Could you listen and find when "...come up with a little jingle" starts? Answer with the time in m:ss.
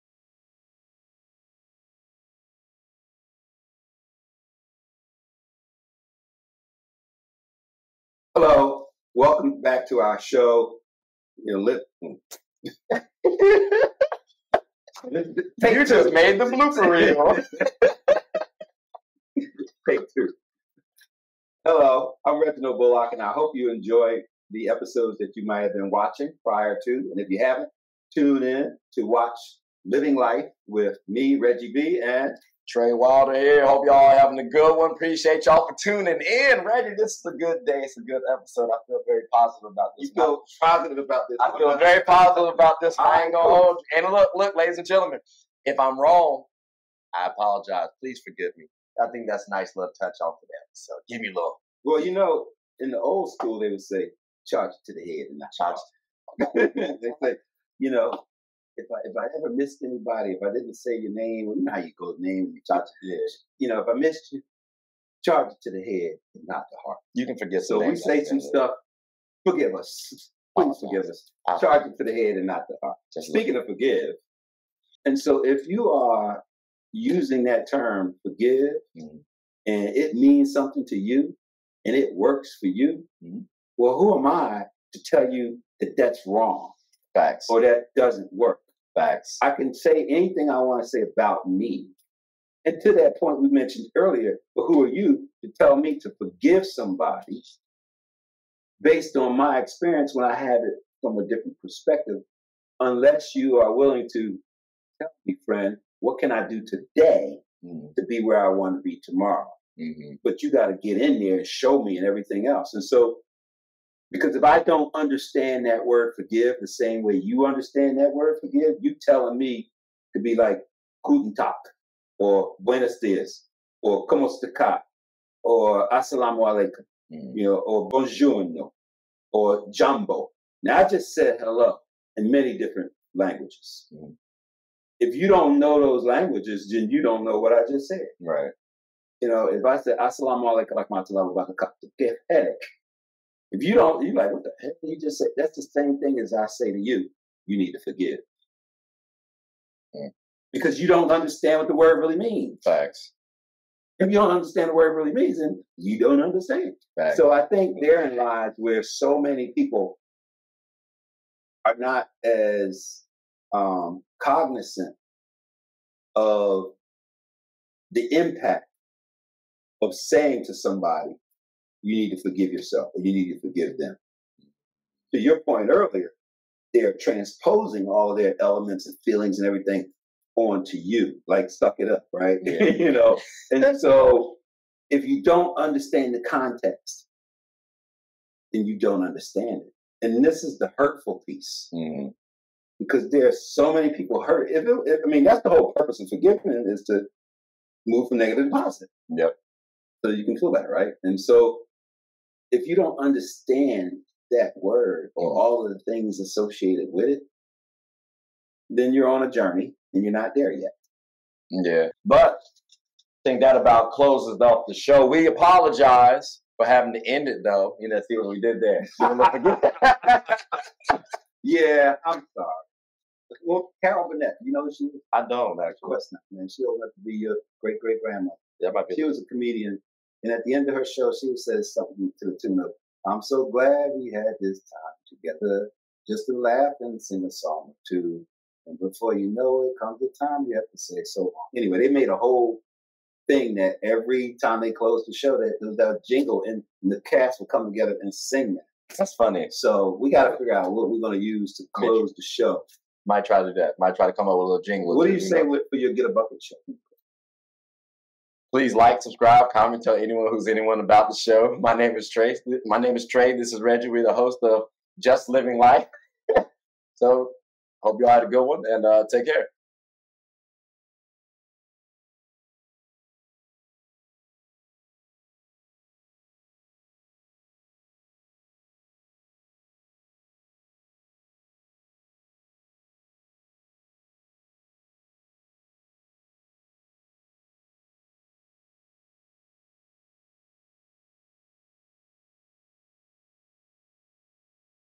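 4:14.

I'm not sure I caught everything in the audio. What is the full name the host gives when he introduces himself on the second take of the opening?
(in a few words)
Reginald Bullock.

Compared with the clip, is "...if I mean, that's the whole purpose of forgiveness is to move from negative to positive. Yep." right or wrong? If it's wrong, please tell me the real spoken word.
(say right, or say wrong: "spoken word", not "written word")
right.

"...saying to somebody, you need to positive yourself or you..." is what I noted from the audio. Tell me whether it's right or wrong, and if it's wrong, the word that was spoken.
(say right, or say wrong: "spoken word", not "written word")
wrong: "forgive", not "positive".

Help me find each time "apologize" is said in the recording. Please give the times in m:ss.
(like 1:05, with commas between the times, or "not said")
0:47, 3:35.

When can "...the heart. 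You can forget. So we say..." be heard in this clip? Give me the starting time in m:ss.
1:06.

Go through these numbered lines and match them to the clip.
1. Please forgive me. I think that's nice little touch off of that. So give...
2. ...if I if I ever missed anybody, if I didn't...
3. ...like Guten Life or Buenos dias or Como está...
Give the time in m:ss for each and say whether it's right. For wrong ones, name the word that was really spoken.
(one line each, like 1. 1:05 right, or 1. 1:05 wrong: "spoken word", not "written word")
1. 0:47 right
2. 0:58 right
3. 2:00 wrong: "Tag", not "Life".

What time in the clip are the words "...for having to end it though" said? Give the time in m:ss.
3:36.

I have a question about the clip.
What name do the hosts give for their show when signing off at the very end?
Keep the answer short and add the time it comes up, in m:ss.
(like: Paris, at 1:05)
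Just Living Life, at 4:24.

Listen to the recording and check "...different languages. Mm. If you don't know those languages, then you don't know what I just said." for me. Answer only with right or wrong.
right.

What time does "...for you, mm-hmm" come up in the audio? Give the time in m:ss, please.
1:22.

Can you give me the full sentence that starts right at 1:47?
to be where I want to be tomorrow?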